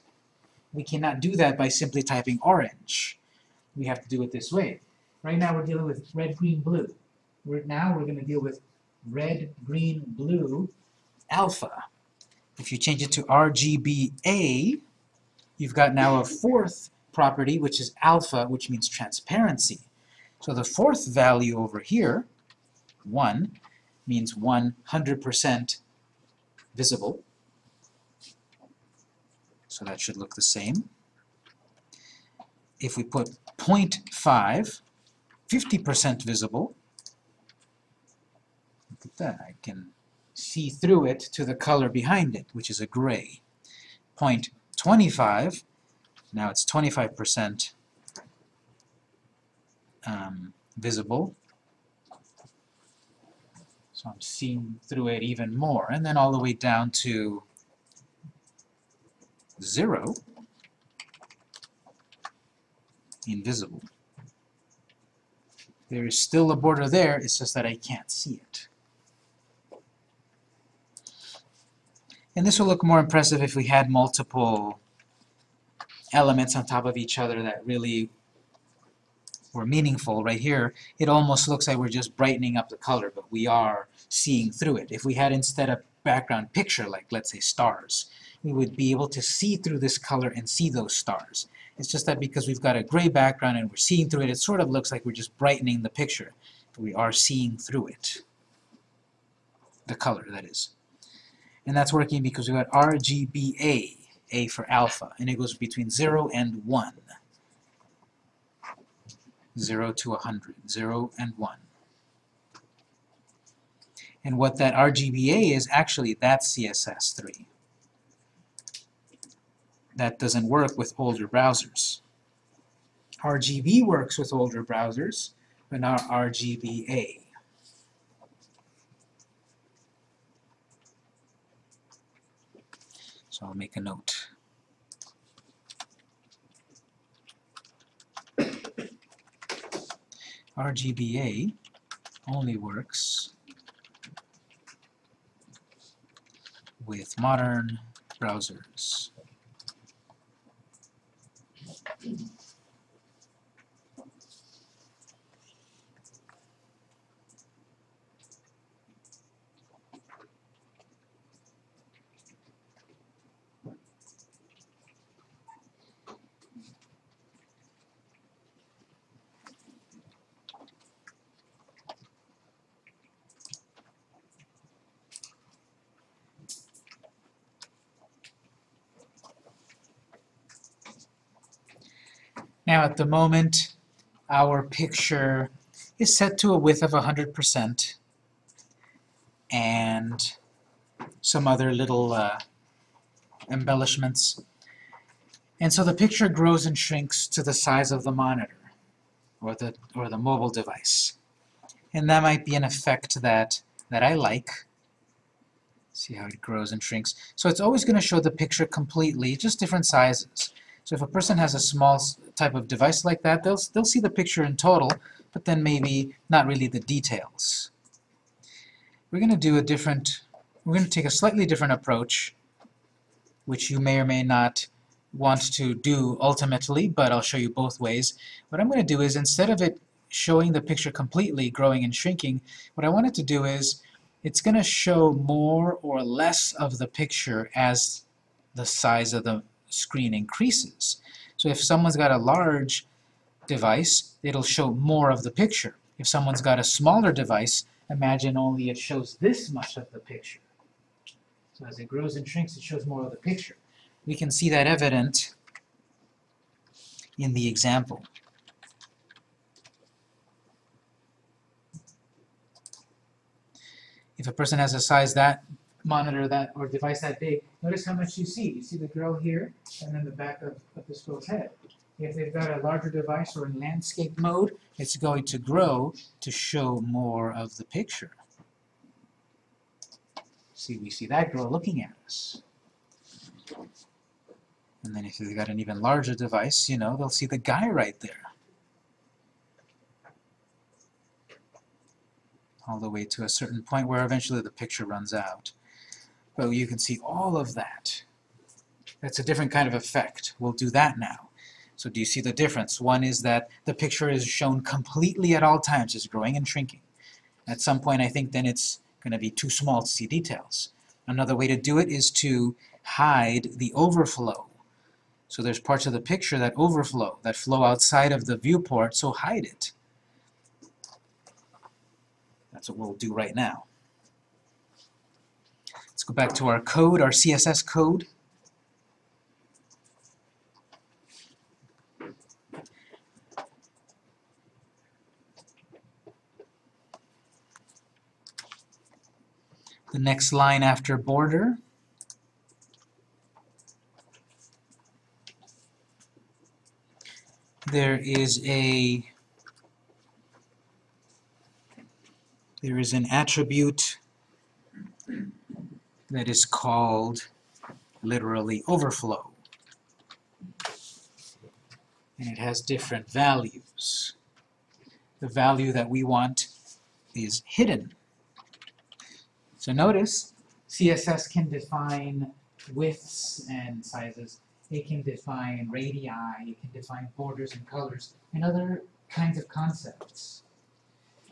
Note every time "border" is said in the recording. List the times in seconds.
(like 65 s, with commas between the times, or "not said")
66 s, 340 s, 377 s.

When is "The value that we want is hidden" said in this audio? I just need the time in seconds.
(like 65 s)
365 s.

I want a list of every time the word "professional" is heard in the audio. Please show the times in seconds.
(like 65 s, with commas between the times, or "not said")
not said.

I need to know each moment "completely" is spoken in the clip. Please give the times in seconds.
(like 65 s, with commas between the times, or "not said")
208 s, 230 s, 304 s.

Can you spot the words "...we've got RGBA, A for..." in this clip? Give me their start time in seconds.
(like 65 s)
102 s.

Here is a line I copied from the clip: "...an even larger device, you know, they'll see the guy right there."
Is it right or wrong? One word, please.
right.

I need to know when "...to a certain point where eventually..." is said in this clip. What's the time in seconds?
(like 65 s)
293 s.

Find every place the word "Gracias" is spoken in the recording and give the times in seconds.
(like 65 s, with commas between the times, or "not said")
152 s.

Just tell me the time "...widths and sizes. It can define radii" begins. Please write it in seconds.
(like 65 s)
372 s.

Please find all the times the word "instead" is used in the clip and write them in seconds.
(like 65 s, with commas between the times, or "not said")
85 s, 229 s.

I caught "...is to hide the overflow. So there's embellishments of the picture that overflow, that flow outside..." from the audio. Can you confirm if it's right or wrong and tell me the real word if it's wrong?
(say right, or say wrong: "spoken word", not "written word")
wrong: "parts", not "embellishments".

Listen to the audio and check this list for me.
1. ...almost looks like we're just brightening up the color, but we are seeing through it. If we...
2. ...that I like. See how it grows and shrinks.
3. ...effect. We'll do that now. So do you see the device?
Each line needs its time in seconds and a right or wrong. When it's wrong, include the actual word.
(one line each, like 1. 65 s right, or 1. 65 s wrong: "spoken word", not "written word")
1. 81 s right
2. 203 s right
3. 299 s wrong: "difference", not "device".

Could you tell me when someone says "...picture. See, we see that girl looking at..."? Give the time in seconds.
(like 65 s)
277 s.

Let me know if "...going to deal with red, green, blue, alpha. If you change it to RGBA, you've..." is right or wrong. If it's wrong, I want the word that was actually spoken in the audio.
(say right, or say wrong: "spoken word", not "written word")
right.